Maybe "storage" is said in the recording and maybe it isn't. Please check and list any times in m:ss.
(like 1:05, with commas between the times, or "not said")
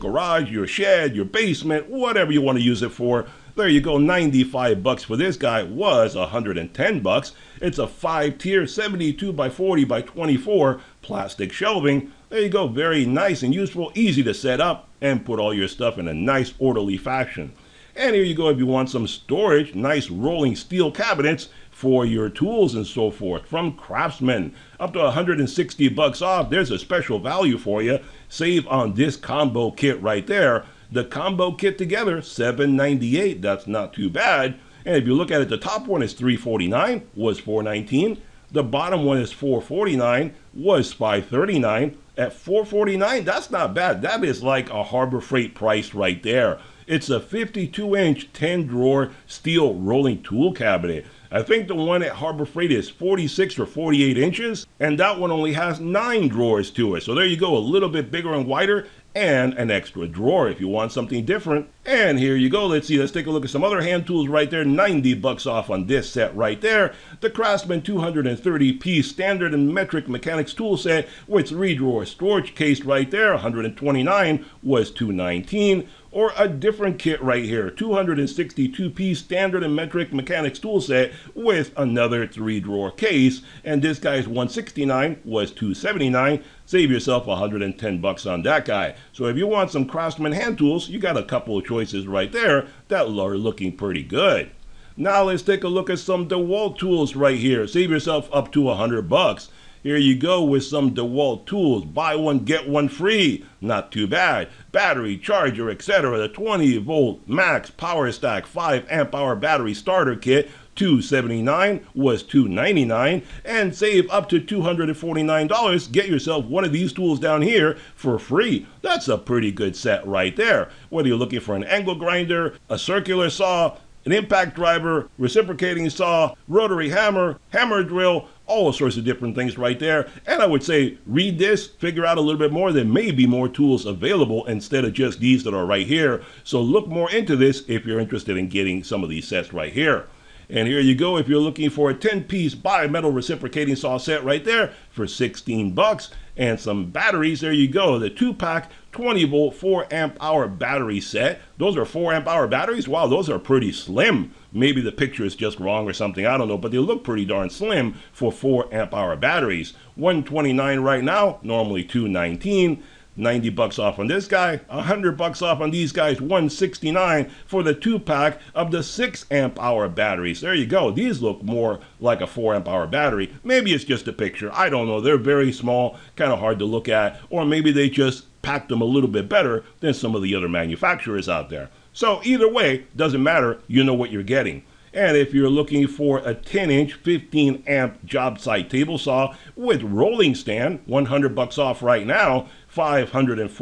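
0:19, 1:12.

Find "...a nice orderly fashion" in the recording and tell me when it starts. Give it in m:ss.
0:16.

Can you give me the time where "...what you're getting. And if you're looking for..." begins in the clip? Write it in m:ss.
3:03.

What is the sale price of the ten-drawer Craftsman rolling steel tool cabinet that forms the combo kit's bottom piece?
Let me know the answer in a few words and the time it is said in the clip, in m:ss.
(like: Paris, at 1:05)
$449, at 0:38.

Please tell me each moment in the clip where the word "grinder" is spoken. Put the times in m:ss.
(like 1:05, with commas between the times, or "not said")
2:01.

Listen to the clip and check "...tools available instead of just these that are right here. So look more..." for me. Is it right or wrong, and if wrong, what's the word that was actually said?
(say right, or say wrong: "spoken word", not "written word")
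right.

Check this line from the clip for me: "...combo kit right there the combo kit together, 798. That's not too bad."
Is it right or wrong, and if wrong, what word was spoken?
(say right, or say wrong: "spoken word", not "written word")
right.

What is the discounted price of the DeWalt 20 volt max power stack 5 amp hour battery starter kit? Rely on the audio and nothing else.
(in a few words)
$279.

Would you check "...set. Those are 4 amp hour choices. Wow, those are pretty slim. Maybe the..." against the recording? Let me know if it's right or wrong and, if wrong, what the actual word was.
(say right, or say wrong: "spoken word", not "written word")
wrong: "batteries", not "choices".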